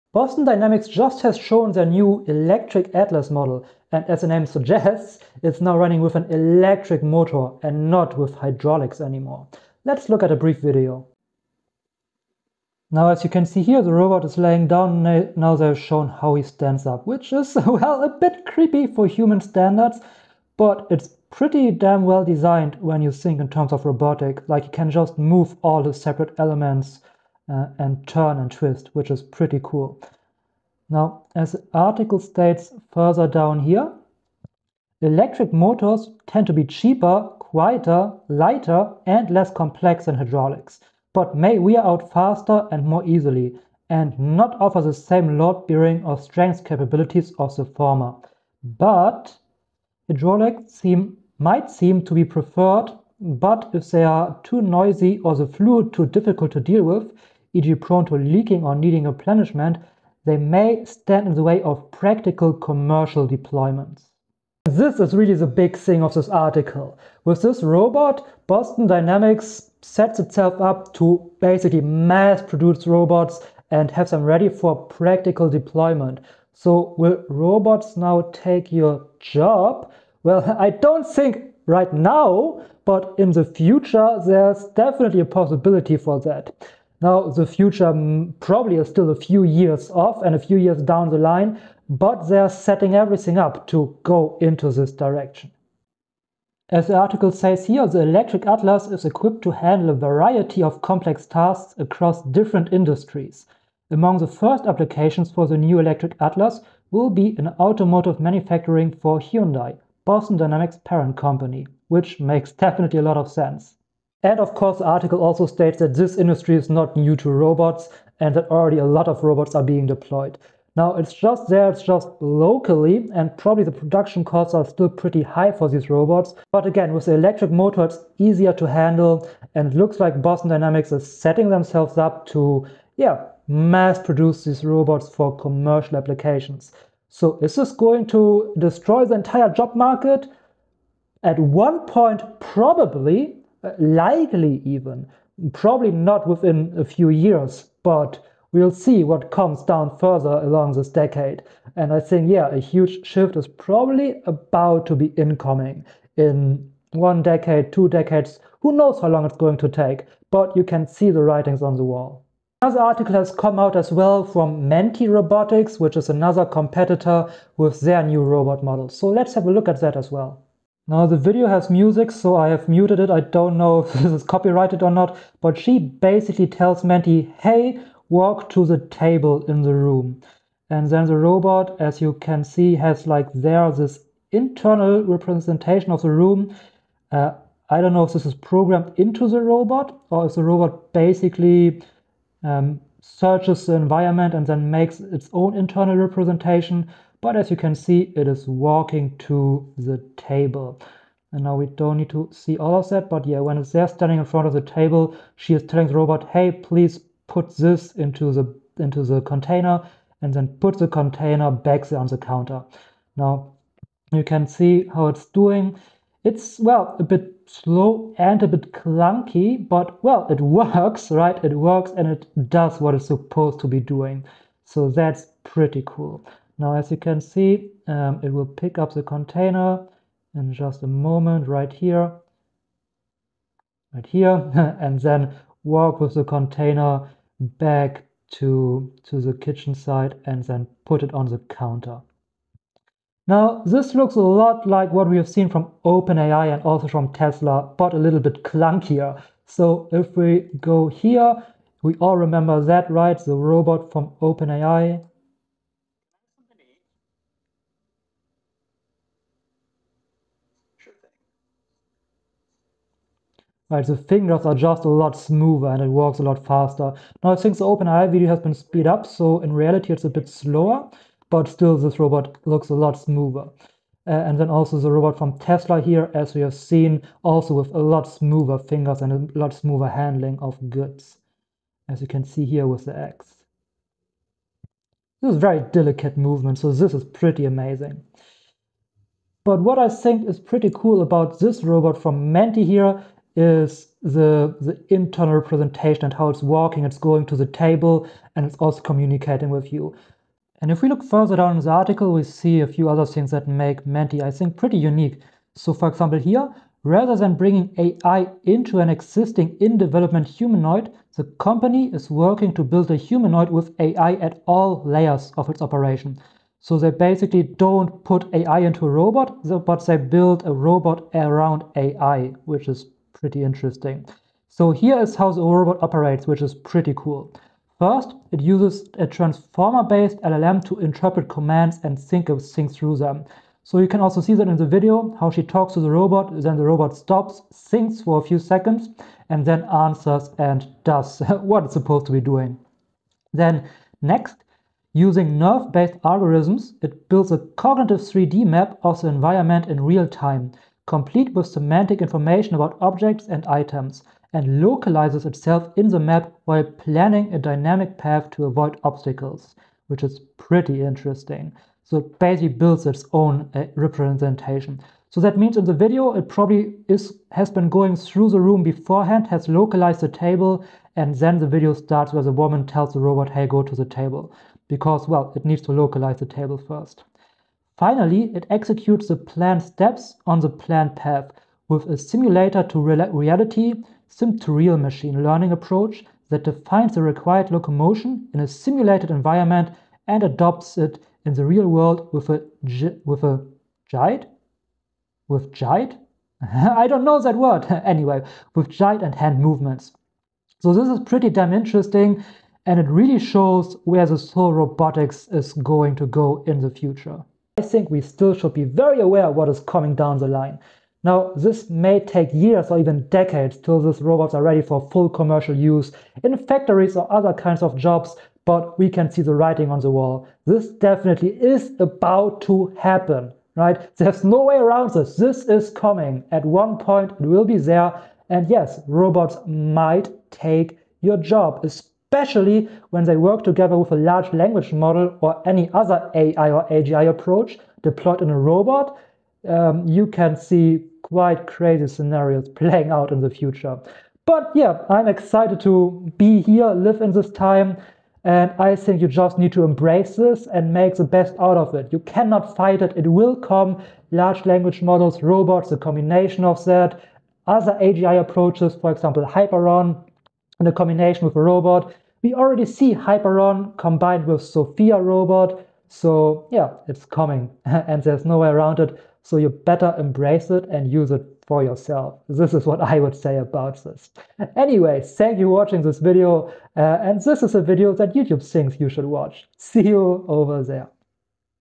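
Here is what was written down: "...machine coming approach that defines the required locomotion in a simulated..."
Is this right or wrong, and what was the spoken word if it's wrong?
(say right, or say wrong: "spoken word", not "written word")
wrong: "learning", not "coming".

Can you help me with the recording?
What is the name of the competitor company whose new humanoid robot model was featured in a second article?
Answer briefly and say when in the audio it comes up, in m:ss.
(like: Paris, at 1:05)
Mentee Robotics, at 2:44.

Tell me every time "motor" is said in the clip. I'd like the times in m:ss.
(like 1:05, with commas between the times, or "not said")
0:07, 0:35, 2:07.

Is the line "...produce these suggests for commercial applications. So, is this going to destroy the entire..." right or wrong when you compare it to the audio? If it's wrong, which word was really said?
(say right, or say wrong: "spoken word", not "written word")
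wrong: "robots", not "suggests".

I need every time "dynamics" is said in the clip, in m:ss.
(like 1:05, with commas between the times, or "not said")
0:00, 1:08, 1:50, 2:10, 5:57.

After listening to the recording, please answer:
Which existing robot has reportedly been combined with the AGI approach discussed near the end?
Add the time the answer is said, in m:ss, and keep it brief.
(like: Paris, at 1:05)
Sophia, at 7:44.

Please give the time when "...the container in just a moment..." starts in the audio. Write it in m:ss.
3:48.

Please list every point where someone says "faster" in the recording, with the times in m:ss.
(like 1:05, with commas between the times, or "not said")
0:42, 4:26.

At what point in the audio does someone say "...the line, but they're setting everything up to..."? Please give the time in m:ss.
1:31.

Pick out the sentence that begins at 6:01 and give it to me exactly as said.
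So it basically builds its own uh, representation.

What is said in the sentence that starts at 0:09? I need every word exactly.
Let's look at a brief video.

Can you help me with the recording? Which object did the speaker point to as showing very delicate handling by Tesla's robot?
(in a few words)
The X.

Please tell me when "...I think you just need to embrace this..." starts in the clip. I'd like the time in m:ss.
7:28.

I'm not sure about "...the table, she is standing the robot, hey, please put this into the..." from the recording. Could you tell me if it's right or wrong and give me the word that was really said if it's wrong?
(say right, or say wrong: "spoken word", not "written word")
wrong: "telling", not "standing".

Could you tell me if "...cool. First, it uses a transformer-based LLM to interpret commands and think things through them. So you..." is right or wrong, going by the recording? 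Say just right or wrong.
right.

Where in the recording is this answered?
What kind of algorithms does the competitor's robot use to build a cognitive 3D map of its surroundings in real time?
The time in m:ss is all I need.
5:45.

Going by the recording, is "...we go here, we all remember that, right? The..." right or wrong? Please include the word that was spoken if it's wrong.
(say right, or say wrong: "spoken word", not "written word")
right.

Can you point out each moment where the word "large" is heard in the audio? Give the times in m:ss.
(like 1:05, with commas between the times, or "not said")
7:13, 7:34.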